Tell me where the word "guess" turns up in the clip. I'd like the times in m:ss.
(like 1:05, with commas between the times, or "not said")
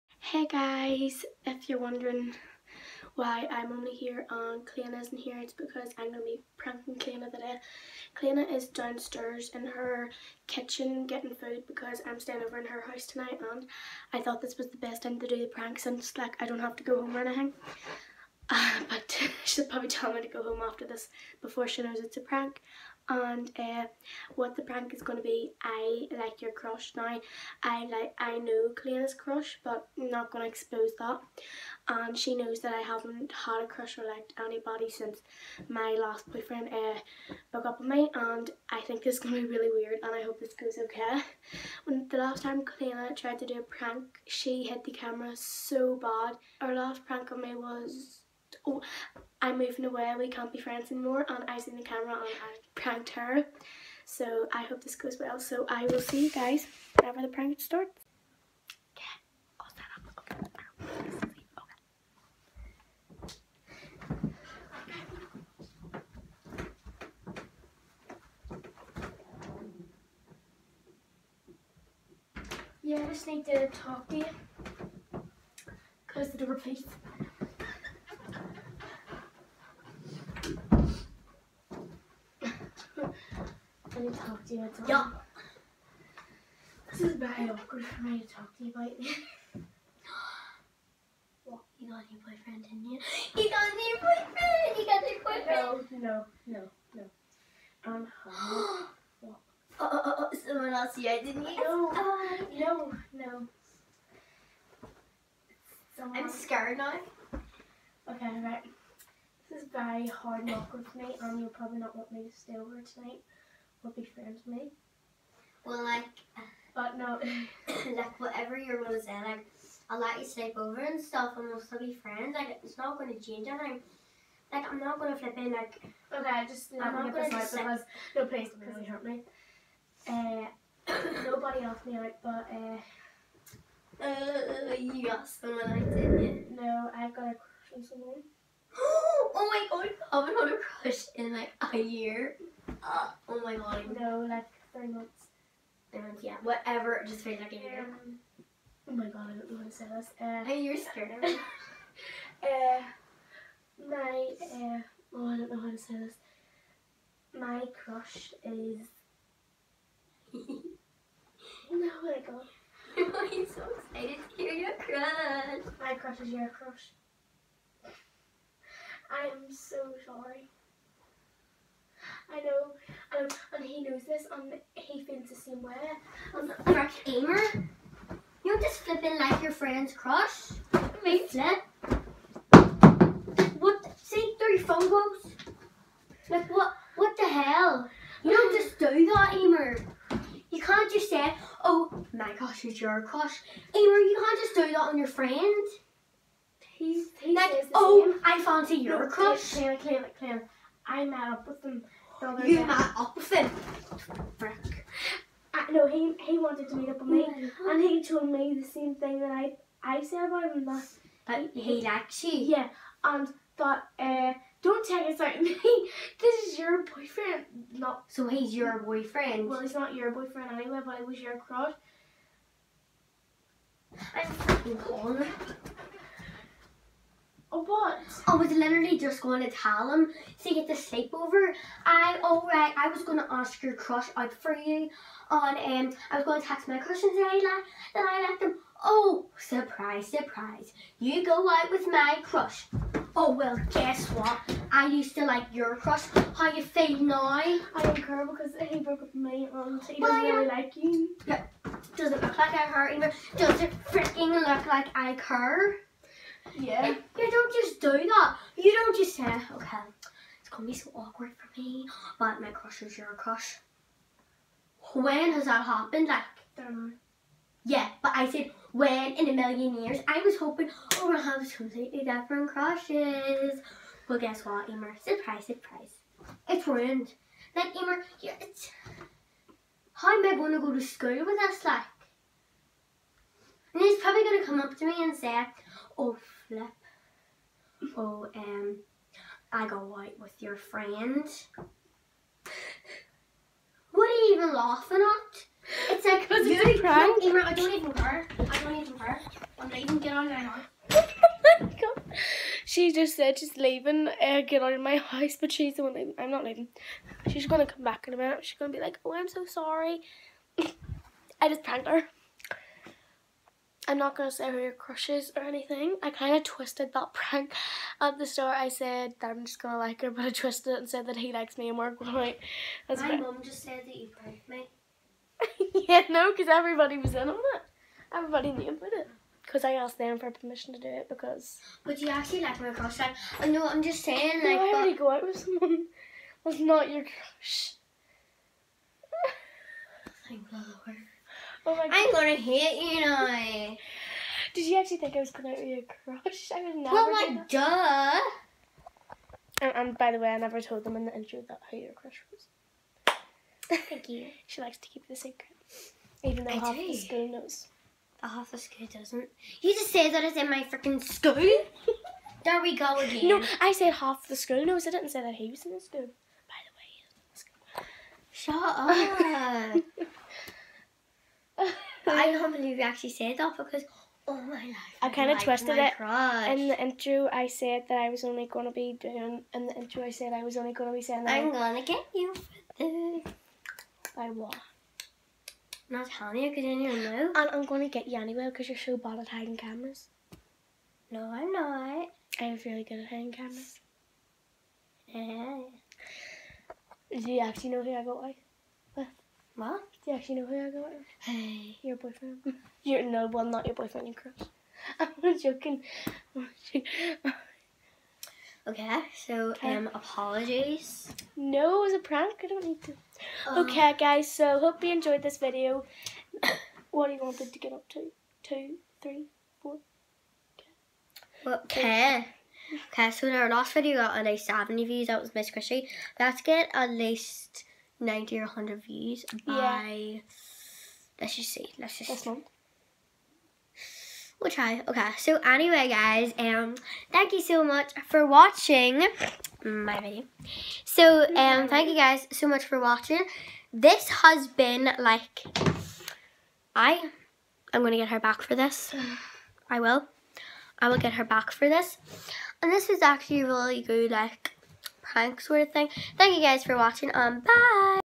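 4:03, 4:34.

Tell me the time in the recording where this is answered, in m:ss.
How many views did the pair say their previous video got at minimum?
7:04.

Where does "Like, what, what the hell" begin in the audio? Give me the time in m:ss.
3:06.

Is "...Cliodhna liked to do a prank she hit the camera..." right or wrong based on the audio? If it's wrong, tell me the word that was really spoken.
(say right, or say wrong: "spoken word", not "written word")
wrong: "tried", not "liked".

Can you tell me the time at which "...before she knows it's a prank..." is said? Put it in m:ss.
0:21.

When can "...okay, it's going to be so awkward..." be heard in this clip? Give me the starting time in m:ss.
4:19.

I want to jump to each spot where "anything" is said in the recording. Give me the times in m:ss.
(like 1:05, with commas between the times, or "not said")
0:17, 2:03, 5:15.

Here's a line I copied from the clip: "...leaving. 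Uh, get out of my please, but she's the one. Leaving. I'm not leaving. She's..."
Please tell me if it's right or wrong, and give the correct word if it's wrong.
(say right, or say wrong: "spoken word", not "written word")
wrong: "house", not "please".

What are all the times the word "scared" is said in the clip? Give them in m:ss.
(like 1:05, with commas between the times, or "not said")
1:46, 2:30.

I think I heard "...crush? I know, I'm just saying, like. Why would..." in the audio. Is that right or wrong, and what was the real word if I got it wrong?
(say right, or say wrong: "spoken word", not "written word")
right.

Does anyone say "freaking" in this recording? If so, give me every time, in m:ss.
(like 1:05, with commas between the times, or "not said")
3:44, 4:13, 6:00.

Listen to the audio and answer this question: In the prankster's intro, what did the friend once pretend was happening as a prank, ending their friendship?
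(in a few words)
moving away.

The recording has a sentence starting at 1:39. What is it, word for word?
oh, oh, oh, someone else here, didn't you?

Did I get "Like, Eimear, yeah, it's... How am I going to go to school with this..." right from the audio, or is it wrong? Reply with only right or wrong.
right.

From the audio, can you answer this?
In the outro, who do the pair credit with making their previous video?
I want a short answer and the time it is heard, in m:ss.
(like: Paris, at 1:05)
Miss Chrissy, at 7:05.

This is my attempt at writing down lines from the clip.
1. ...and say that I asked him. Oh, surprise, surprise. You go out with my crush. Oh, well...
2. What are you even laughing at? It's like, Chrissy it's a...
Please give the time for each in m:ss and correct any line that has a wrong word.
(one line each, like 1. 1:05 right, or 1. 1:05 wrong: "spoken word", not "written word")
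1. 3:57 right
2. 4:53 wrong: "Cause", not "Chrissy".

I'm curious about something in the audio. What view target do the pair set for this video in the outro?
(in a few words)
90 or 100.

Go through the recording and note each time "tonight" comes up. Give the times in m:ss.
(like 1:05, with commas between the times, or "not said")
0:13, 1:52.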